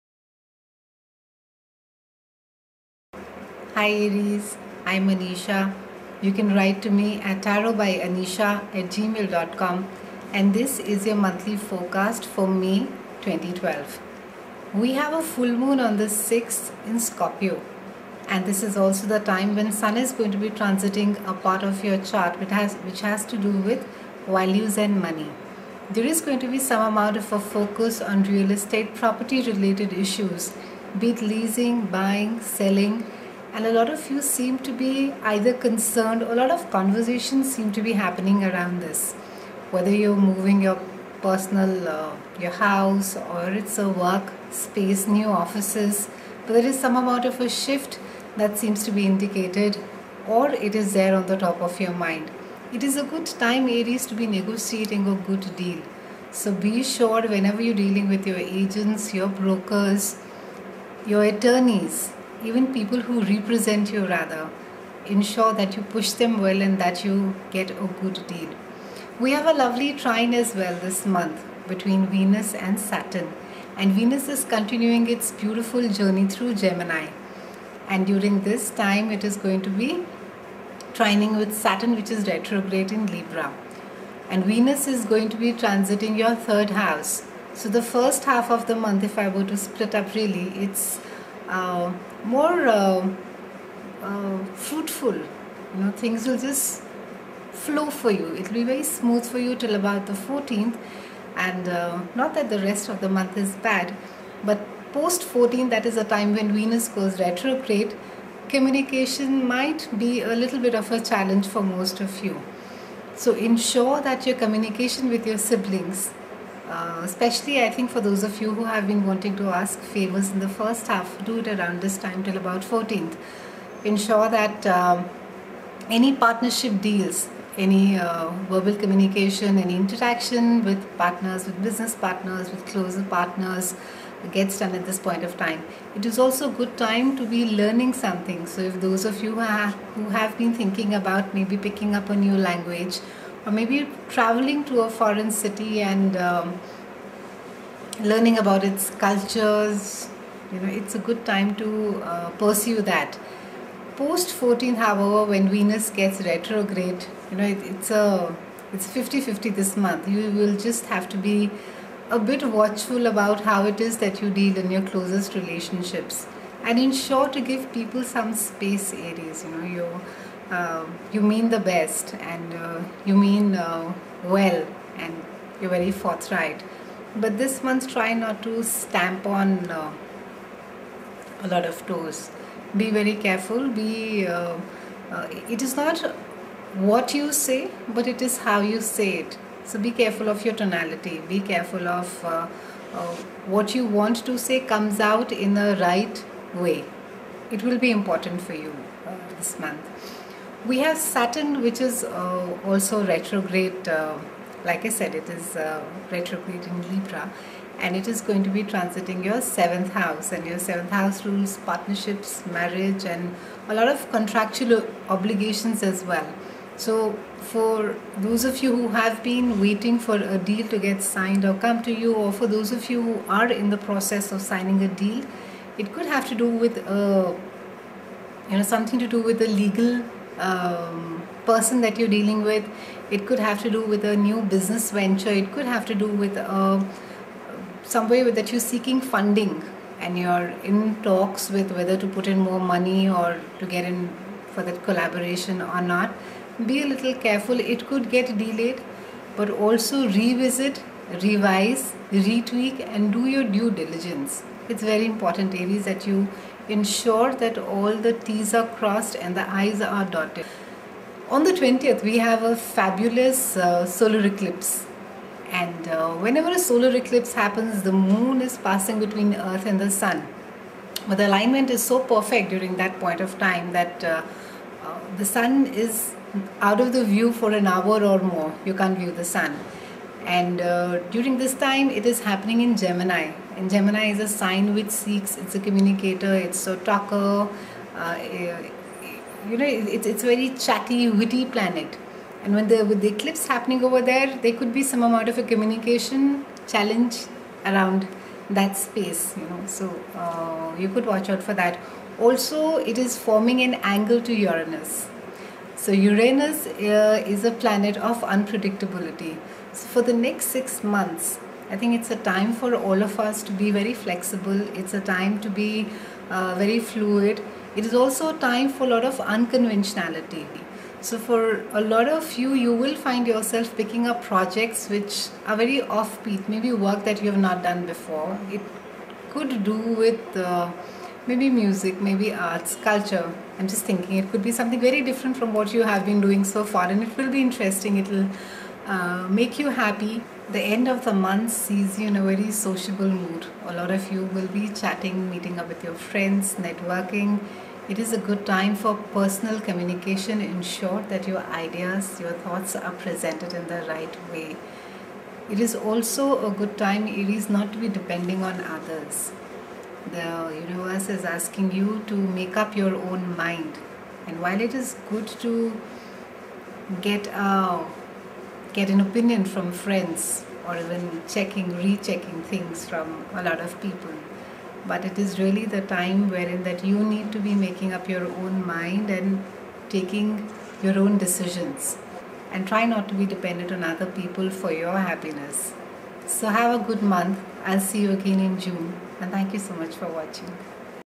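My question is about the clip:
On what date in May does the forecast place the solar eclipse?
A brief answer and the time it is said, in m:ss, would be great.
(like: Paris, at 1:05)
20th, at 4:21.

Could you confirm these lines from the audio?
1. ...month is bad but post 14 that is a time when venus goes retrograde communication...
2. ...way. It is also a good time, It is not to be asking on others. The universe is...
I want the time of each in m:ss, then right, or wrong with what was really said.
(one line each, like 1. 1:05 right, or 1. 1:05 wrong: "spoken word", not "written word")
1. 1:43 right
2. 5:54 wrong: "depending", not "asking".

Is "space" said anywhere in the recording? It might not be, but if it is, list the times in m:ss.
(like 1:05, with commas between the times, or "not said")
0:44, 2:48, 4:58.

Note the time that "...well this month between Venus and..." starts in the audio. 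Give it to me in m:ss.
1:10.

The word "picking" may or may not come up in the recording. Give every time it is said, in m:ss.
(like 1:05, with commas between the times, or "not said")
2:21, 5:23.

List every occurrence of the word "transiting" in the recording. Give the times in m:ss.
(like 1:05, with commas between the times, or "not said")
0:20, 1:25, 3:28.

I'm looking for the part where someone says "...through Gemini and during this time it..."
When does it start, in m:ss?
1:16.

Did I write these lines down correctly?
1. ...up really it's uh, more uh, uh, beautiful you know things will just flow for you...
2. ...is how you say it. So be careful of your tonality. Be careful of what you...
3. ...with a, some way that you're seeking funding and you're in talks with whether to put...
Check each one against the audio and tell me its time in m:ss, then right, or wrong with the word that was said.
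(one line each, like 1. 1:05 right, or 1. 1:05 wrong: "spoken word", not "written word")
1. 1:29 wrong: "fruitful", not "beautiful"
2. 3:08 right
3. 3:56 right.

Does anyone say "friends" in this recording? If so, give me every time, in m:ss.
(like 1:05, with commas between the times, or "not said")
5:45, 6:09.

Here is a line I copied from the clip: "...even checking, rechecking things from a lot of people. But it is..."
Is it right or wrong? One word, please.
right.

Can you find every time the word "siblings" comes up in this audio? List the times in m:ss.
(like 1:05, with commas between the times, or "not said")
1:55.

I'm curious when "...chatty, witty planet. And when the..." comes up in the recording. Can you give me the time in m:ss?
4:50.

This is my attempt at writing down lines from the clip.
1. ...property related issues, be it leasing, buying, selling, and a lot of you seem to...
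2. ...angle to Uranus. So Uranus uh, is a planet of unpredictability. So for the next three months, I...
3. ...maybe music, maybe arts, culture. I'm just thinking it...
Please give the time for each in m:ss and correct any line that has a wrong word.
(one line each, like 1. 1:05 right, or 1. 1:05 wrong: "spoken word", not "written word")
1. 0:28 right
2. 5:03 wrong: "six", not "three"
3. 5:31 right.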